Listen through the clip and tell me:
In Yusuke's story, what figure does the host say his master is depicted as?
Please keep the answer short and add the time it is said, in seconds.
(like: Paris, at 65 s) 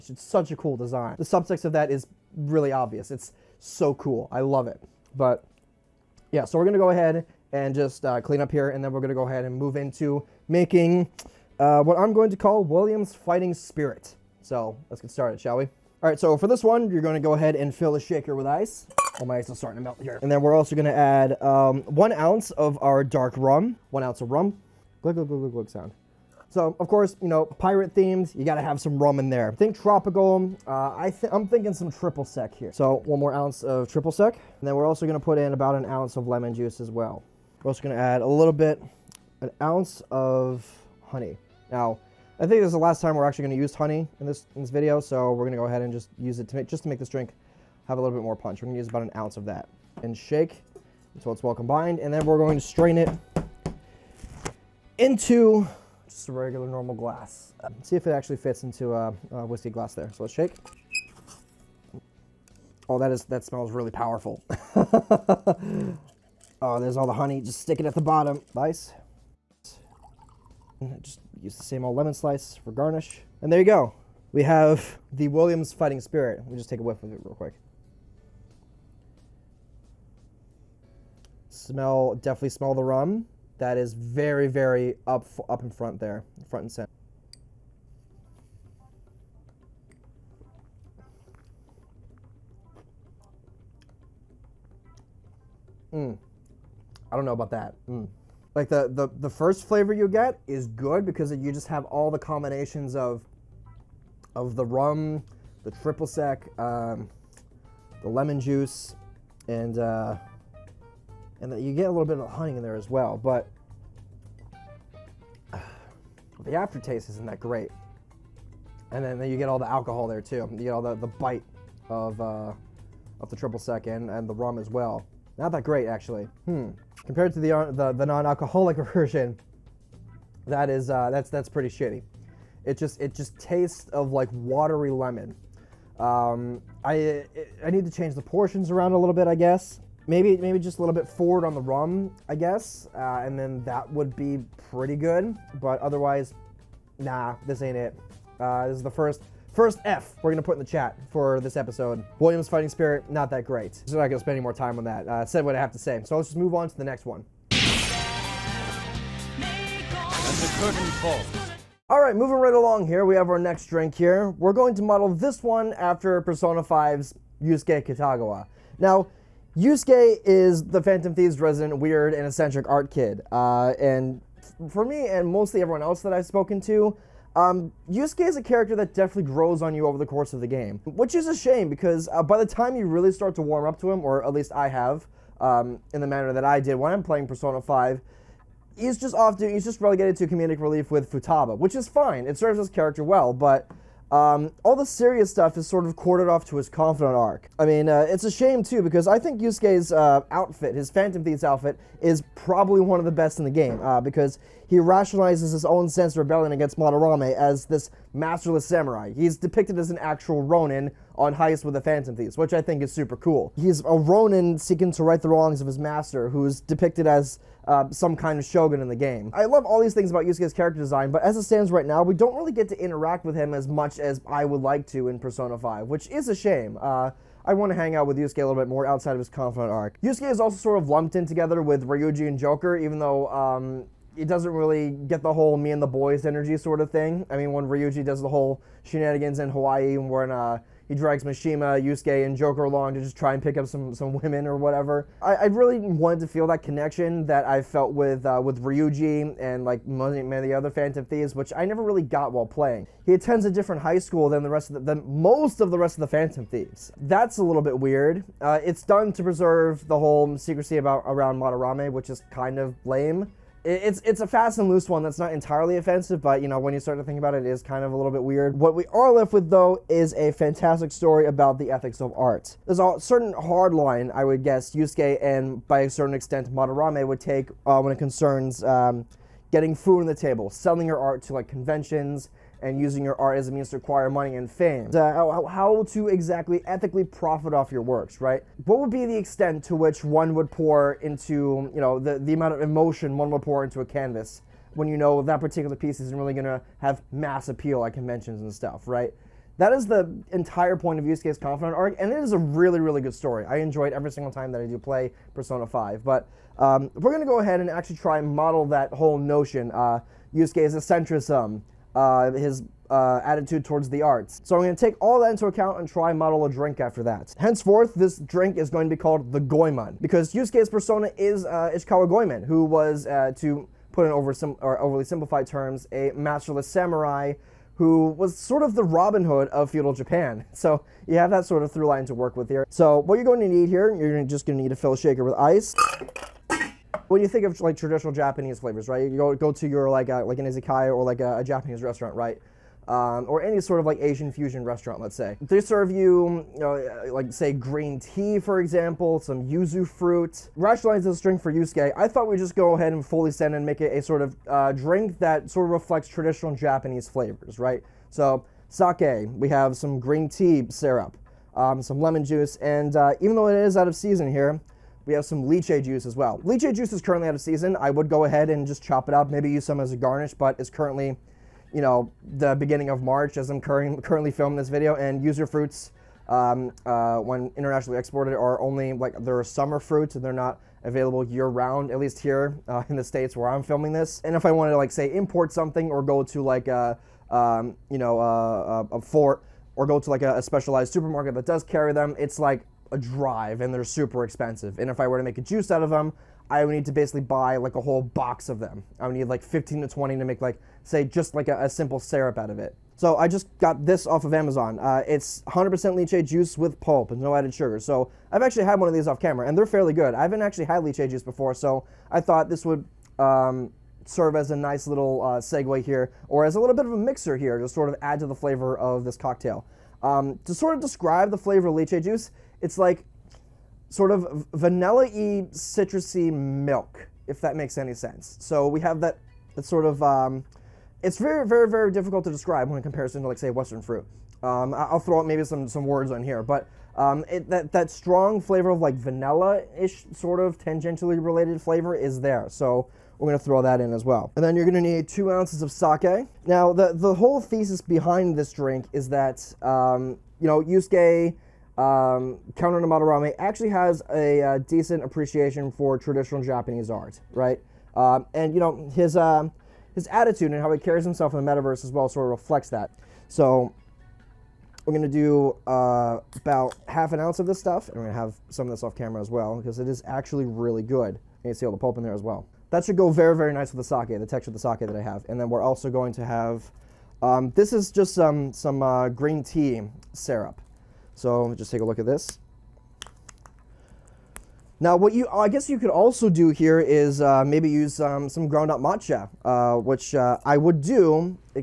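shogun, at 218 s.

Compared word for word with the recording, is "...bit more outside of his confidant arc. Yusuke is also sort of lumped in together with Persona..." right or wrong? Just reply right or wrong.
wrong.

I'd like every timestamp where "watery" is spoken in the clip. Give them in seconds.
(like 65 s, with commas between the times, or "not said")
134 s.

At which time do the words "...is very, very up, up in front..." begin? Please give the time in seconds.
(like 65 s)
83 s.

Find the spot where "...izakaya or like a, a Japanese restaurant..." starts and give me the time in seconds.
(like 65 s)
340 s.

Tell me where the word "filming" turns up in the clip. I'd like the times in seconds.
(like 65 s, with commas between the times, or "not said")
374 s, 383 s.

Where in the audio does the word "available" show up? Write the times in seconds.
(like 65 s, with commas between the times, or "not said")
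380 s.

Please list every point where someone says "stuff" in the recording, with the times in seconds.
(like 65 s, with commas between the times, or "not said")
195 s, 298 s, 467 s.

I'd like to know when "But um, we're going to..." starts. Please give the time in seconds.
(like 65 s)
306 s.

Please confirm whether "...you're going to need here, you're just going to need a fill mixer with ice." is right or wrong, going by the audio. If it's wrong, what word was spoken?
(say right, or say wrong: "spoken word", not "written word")
wrong: "shaker", not "mixer".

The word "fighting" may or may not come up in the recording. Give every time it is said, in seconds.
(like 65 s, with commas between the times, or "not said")
13 s, 75 s, 152 s.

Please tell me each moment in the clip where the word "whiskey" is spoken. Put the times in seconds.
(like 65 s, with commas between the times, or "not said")
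59 s.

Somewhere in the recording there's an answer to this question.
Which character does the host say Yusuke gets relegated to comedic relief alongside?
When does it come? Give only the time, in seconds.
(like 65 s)
191 s.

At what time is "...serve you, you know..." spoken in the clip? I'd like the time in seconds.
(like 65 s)
345 s.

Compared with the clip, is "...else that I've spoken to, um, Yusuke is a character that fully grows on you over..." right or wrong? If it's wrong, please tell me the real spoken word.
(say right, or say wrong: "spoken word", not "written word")
wrong: "definitely", not "fully".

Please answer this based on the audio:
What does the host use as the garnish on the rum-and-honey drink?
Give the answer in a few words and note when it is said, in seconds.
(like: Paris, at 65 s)
lemon slice, at 71 s.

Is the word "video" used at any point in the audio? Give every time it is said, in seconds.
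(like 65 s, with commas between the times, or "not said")
44 s, 374 s.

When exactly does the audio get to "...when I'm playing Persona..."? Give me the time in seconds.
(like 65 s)
186 s.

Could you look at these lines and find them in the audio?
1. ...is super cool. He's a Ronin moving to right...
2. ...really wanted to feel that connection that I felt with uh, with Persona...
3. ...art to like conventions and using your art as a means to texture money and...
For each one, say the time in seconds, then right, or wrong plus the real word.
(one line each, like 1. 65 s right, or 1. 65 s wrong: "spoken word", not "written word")
1. 212 s wrong: "seeking", not "moving"
2. 245 s wrong: "Ryuji", not "Persona"
3. 280 s wrong: "acquire", not "texture".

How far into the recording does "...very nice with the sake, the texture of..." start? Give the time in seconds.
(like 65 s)
473 s.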